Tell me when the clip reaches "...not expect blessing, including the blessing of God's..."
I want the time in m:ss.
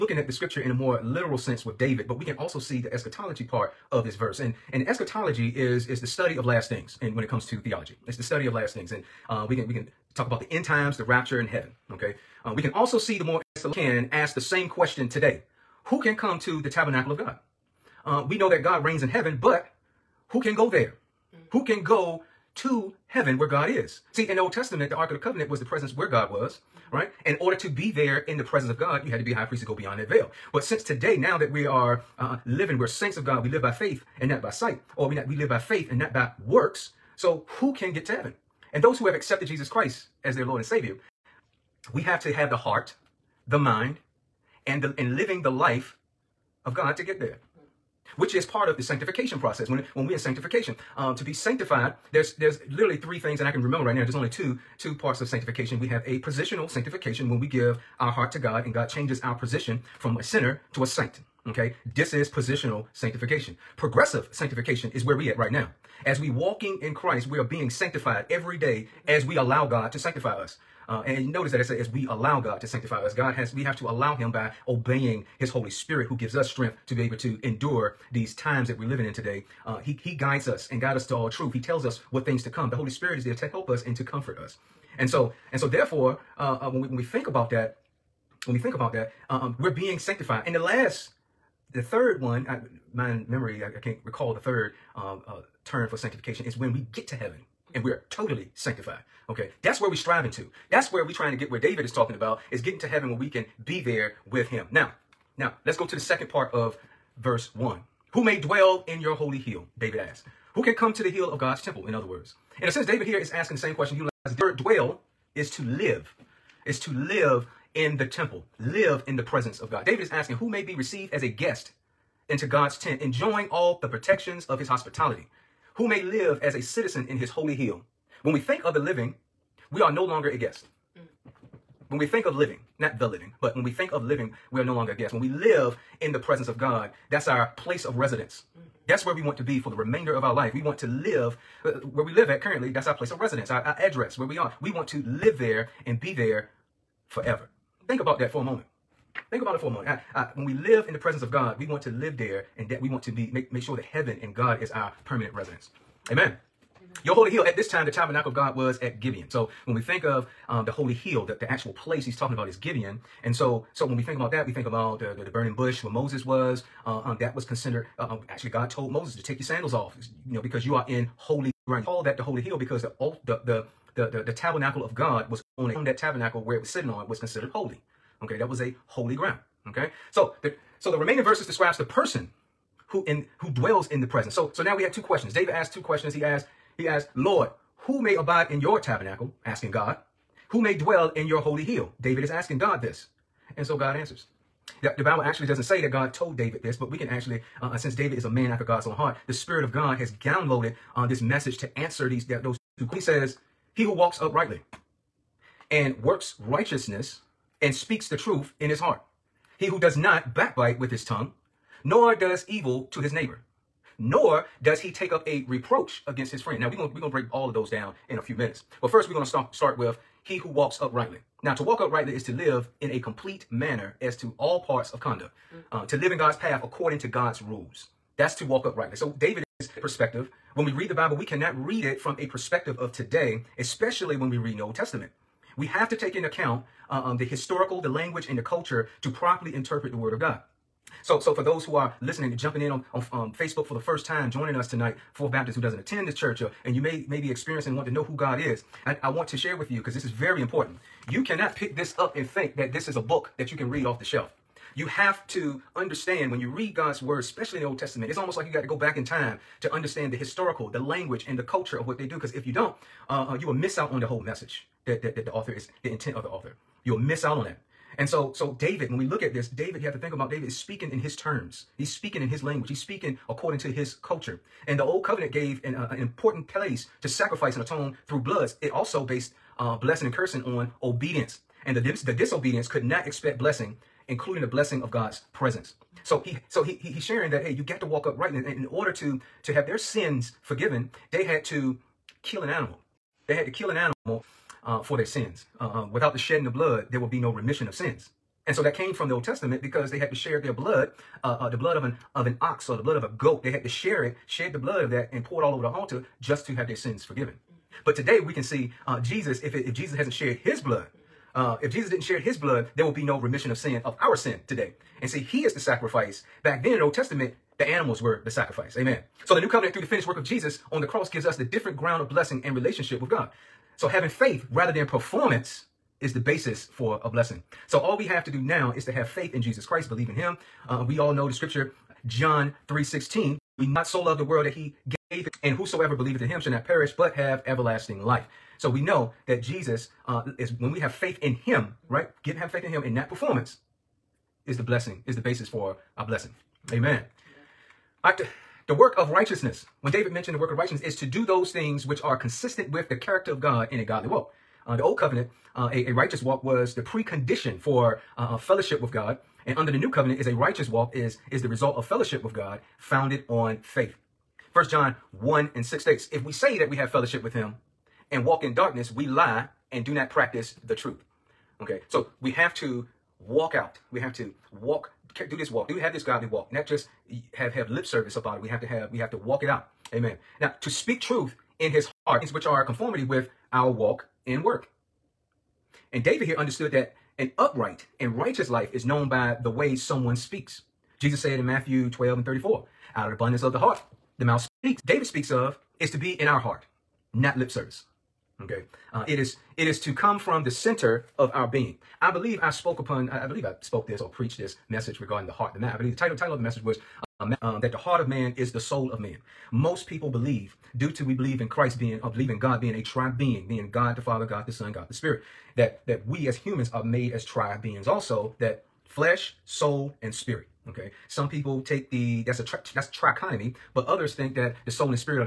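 4:42.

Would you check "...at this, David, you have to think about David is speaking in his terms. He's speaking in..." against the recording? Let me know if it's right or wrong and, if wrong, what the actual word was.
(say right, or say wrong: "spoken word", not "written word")
right.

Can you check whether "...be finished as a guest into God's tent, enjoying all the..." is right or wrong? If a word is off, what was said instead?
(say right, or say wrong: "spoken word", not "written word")
wrong: "received", not "finished".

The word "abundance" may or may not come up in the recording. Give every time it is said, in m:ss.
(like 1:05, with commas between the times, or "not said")
6:33.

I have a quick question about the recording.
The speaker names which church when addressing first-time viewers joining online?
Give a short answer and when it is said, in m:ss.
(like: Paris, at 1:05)
Fourth Baptist, at 4:05.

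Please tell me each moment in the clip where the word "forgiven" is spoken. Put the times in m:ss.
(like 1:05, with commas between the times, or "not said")
4:50, 5:07.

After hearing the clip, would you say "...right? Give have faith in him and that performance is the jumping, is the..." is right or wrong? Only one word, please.
wrong.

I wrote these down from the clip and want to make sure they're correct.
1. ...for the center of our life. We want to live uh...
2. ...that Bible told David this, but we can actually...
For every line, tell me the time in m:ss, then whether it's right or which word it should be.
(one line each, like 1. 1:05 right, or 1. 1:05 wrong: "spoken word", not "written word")
1. 2:19 wrong: "remainder", not "center"
2. 3:15 wrong: "God", not "Bible".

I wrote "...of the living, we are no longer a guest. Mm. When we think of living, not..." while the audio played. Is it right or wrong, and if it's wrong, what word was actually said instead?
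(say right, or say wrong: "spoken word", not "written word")
right.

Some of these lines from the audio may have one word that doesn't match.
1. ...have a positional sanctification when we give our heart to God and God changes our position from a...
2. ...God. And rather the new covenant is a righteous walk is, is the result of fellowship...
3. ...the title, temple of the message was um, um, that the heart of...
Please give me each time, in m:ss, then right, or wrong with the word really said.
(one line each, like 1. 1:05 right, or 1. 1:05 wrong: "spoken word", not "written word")
1. 0:55 right
2. 5:58 wrong: "under", not "rather"
3. 6:45 wrong: "title", not "temple".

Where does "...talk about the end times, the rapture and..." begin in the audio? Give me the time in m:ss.
0:10.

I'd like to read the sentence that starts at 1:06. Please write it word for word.
As we walking in Christ, we are being sanctified every day as we allow God to sanctify us.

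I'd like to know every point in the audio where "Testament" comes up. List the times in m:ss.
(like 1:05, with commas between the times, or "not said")
0:24, 3:54, 4:17, 4:59, 5:16.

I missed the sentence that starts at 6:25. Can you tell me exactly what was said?
And David here understood that an upright and righteous life is known by the way someone speaks.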